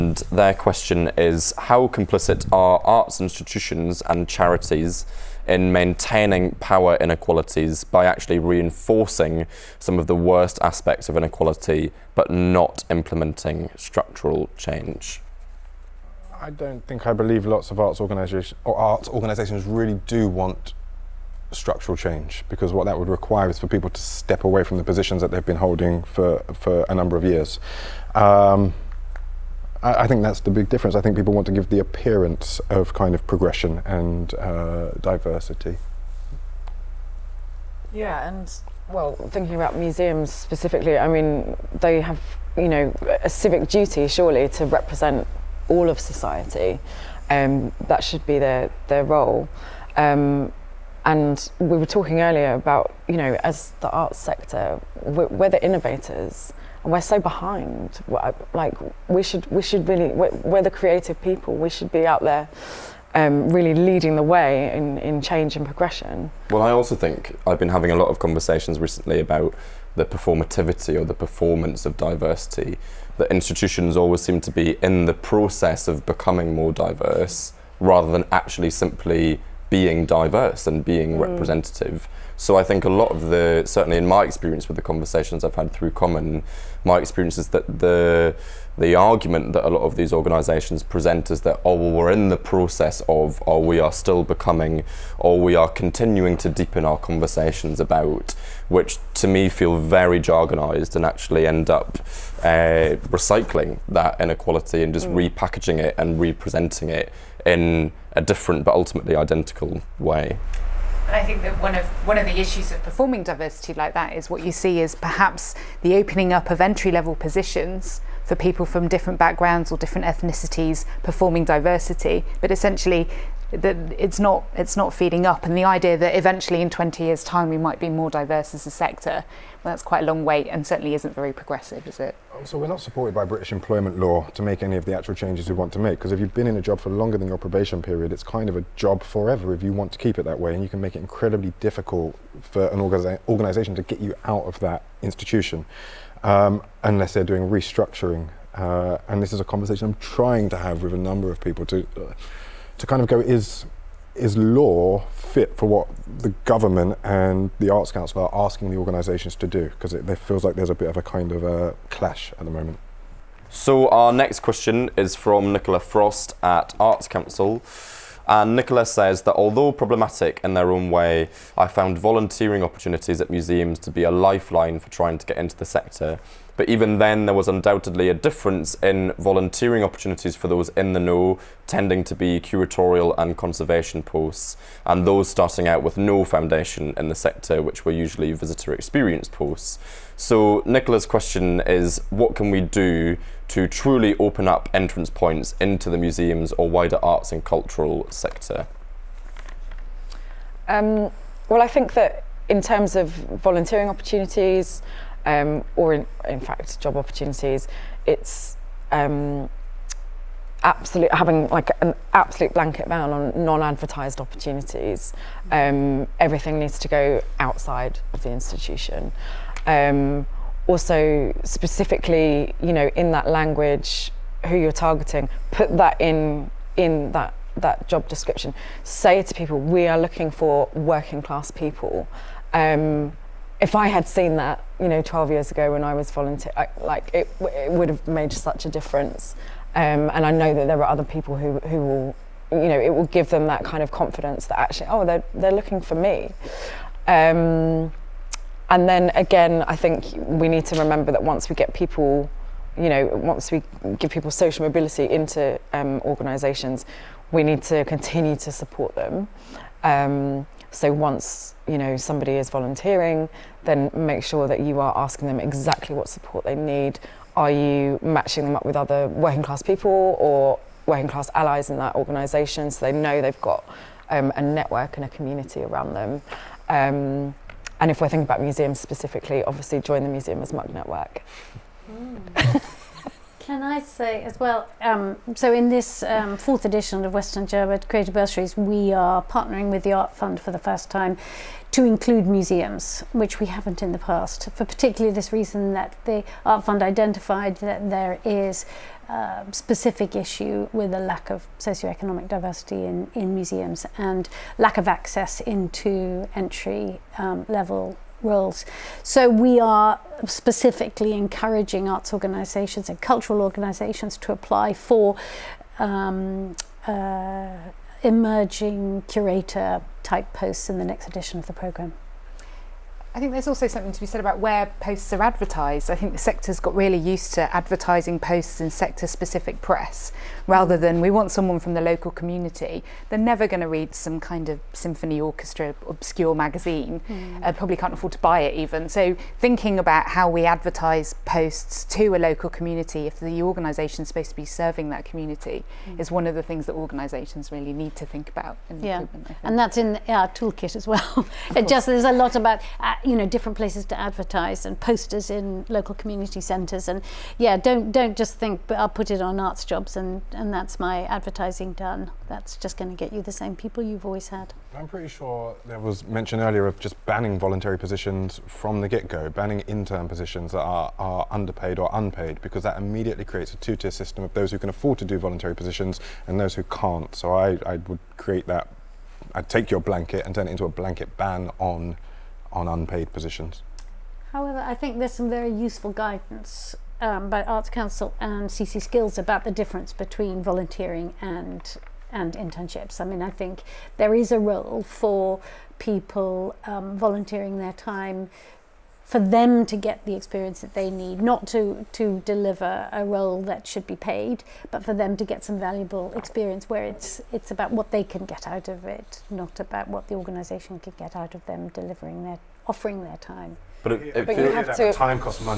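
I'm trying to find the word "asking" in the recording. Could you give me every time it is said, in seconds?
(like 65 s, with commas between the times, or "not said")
158 s, 264 s.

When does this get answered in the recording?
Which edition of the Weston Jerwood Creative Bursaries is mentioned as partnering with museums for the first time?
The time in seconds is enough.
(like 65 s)
286 s.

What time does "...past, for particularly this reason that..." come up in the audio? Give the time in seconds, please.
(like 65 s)
293 s.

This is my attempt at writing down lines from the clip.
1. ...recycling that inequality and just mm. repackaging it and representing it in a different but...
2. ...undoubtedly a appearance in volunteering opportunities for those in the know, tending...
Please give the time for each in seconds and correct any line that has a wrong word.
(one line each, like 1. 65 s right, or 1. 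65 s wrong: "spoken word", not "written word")
1. 103 s right
2. 177 s wrong: "difference", not "appearance".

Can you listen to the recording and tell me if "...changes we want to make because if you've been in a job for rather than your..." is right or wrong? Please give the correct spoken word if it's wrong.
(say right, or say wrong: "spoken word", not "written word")
wrong: "longer", not "rather".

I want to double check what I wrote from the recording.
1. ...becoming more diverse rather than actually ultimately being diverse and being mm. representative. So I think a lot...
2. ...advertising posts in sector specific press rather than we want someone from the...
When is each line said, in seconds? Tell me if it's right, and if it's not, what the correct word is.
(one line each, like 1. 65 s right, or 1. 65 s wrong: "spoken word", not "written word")
1. 76 s wrong: "simply", not "ultimately"
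2. 327 s right.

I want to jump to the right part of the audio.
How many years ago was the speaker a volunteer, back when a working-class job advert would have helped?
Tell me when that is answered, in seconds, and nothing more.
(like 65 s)
235 s.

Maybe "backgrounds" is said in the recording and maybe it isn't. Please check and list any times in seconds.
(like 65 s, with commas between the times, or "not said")
119 s.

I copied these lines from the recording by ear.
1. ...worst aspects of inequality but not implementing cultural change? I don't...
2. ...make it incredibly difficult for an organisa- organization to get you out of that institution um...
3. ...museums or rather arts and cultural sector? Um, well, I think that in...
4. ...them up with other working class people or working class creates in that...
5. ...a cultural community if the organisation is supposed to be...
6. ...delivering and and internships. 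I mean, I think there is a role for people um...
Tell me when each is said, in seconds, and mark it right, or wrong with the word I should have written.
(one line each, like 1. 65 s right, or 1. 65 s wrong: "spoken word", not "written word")
1. 10 s wrong: "structural", not "cultural"
2. 140 s right
3. 195 s wrong: "wider", not "rather"
4. 268 s wrong: "allies", not "creates"
5. 342 s wrong: "local", not "cultural"
6. 390 s wrong: "volunteering", not "delivering".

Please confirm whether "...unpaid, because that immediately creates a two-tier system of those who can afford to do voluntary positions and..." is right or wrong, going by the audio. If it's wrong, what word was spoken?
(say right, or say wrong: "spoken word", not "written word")
right.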